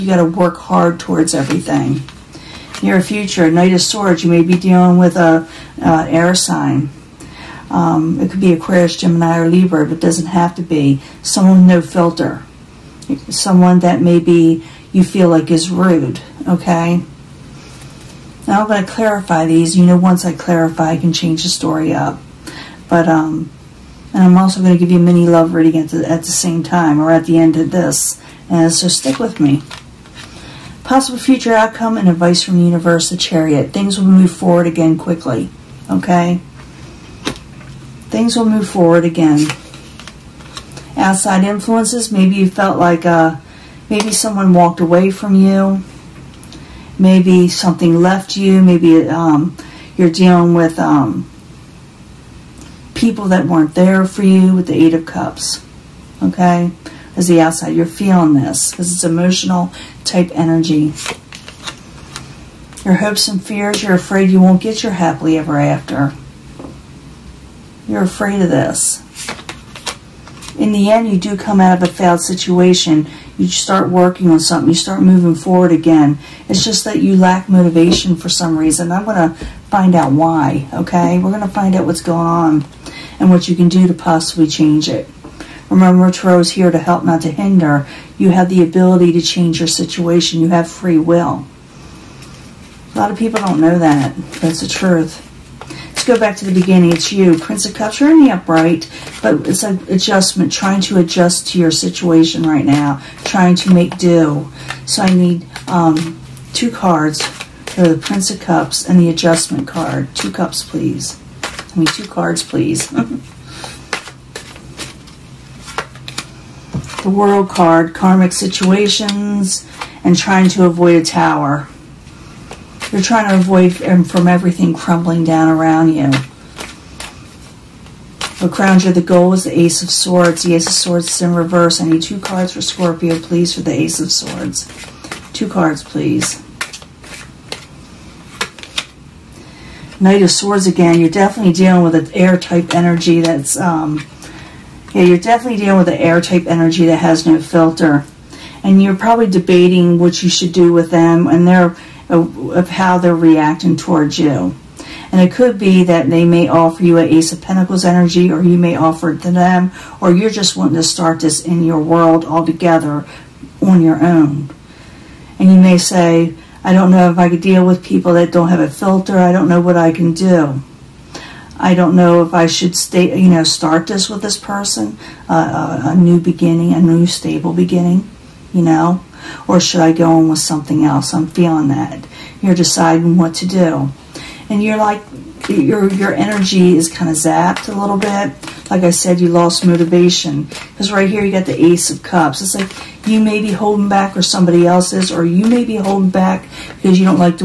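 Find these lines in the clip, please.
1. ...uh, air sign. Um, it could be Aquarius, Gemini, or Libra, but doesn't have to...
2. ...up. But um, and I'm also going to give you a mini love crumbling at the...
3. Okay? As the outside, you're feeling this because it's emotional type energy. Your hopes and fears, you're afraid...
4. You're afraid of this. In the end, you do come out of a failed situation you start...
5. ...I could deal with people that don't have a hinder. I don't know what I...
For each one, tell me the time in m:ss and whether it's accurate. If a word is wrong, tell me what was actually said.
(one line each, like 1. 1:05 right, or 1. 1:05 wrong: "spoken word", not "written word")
1. 0:05 right
2. 0:21 wrong: "reading", not "crumbling"
3. 0:56 right
4. 1:07 right
5. 2:47 wrong: "filter", not "hinder".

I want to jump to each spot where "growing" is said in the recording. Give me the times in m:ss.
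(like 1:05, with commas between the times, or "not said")
not said.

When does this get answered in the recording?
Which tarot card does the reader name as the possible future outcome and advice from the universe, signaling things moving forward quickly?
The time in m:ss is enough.
0:33.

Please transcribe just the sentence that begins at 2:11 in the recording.
I need two cards for Scorpio, please, for the Ace of Swords.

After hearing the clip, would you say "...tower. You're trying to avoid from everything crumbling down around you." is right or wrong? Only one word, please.
right.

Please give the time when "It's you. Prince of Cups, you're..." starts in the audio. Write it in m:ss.
1:36.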